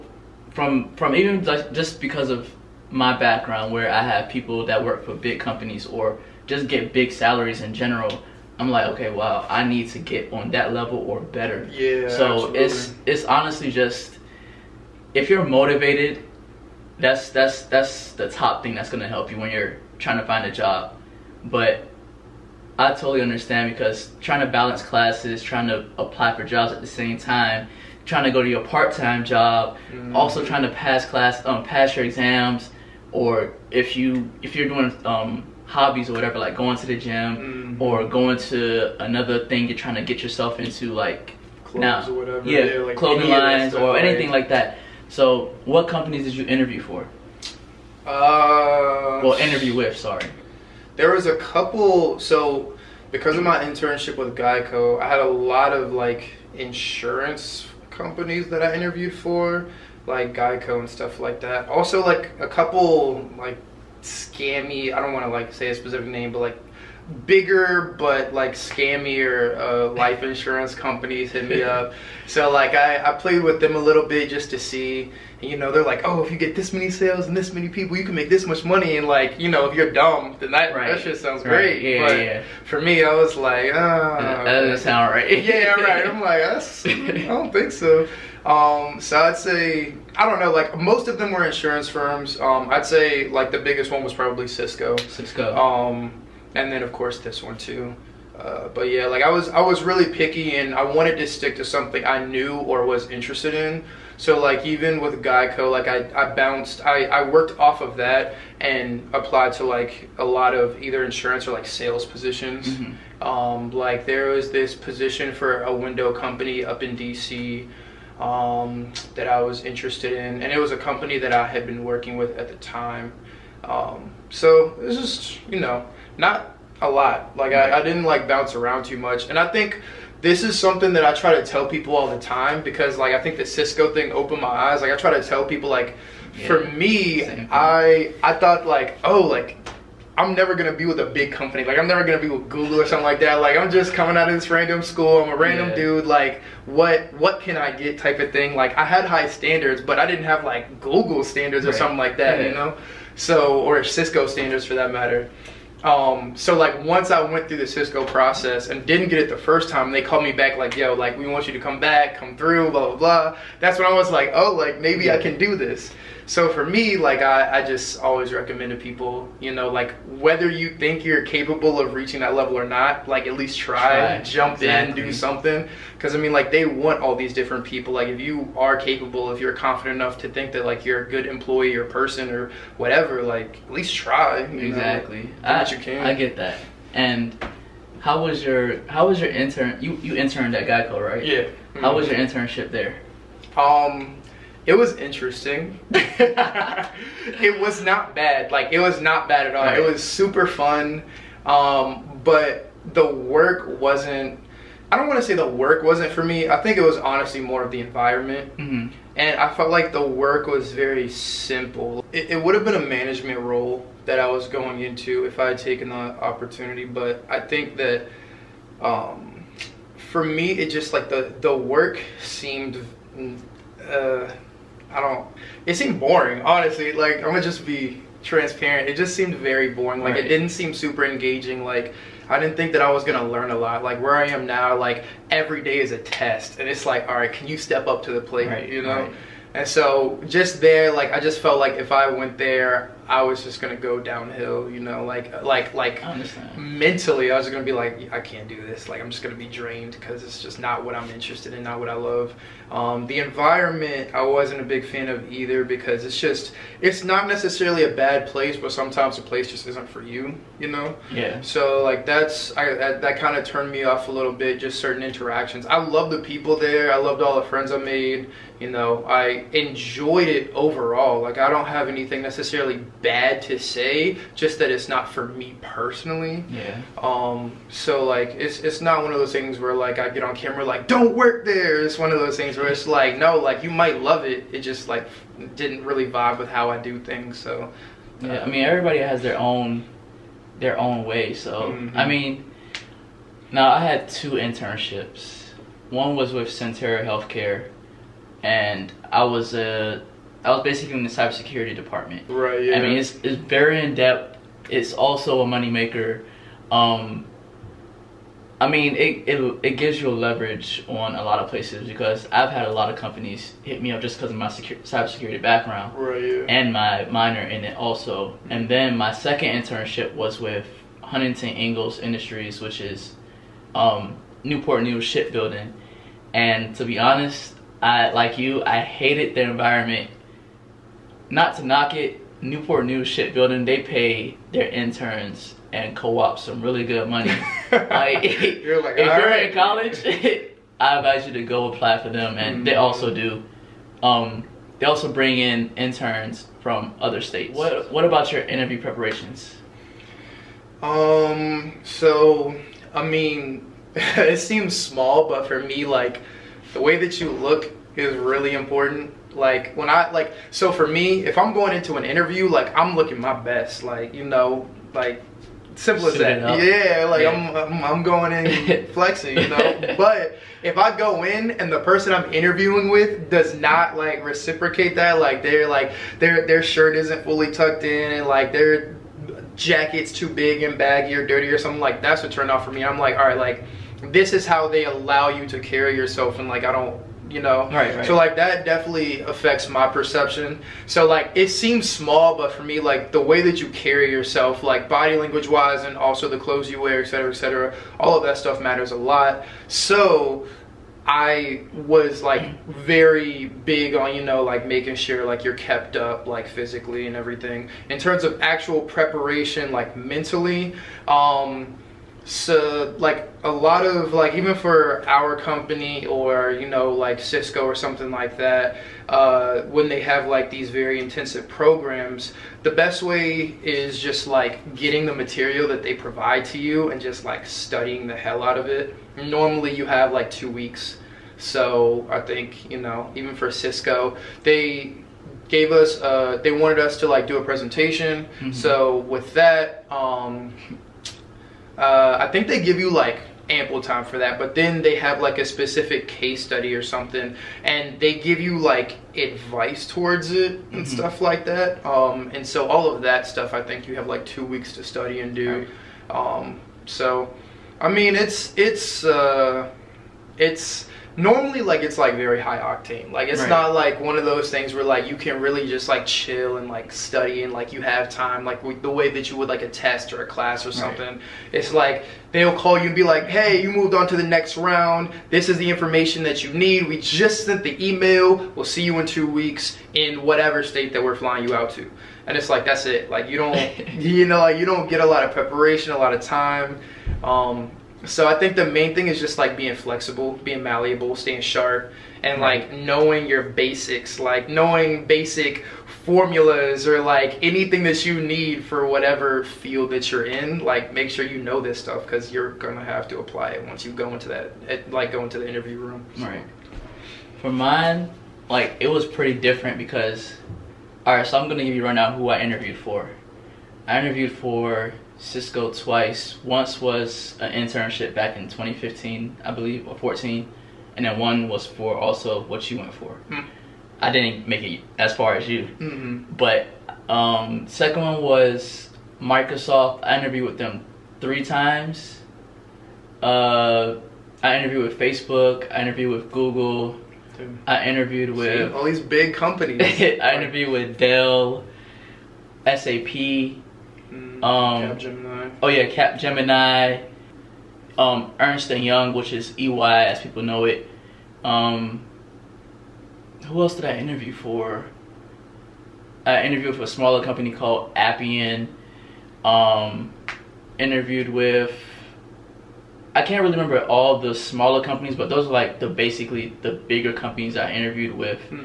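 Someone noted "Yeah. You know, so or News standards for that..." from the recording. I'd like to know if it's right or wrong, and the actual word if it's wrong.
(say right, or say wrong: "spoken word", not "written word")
wrong: "Cisco", not "News".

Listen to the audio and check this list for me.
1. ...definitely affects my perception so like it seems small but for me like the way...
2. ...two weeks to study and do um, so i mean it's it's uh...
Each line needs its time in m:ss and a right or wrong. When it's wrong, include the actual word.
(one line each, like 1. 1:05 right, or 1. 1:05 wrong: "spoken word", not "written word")
1. 6:28 right
2. 7:34 right.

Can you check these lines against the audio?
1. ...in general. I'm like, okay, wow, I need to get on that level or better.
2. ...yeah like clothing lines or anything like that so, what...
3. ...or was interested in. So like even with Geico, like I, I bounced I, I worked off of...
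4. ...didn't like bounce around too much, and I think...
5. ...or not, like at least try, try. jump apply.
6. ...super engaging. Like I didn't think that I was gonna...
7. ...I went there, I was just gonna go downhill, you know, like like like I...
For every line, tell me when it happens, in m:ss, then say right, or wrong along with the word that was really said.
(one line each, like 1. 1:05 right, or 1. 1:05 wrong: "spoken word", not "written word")
1. 0:07 right
2. 0:42 right
3. 1:42 right
4. 2:07 right
5. 2:52 wrong: "exactly", not "apply"
6. 3:50 right
7. 4:01 right.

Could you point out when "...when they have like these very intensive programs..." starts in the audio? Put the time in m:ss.
6:59.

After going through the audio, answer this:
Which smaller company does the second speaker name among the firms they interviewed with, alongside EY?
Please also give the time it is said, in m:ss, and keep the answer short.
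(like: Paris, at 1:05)
Appian, at 9:17.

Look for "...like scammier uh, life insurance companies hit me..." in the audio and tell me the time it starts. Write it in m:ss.
1:08.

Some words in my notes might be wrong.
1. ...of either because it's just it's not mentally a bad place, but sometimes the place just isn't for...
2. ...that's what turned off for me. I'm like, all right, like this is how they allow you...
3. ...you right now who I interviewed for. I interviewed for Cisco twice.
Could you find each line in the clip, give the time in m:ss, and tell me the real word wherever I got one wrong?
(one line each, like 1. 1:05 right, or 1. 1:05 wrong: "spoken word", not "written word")
1. 4:15 wrong: "necessarily", not "mentally"
2. 6:22 right
3. 8:31 right.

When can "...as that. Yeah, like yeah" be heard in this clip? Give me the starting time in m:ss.
6:06.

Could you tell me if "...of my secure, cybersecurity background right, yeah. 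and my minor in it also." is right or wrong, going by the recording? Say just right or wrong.
right.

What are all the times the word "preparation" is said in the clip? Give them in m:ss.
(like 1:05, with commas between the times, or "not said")
5:48, 6:48, 8:05.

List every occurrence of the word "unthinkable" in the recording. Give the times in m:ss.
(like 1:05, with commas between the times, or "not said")
not said.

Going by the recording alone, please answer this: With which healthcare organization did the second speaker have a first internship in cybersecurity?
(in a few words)
Sentara Healthcare.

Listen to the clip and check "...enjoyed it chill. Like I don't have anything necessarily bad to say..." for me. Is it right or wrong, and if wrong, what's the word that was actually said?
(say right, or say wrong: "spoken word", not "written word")
wrong: "overall", not "chill".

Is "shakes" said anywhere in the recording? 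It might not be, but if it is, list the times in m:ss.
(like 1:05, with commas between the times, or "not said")
not said.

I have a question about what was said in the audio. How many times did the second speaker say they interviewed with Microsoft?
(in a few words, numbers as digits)
3.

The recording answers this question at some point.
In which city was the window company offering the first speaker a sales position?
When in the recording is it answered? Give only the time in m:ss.
1:56.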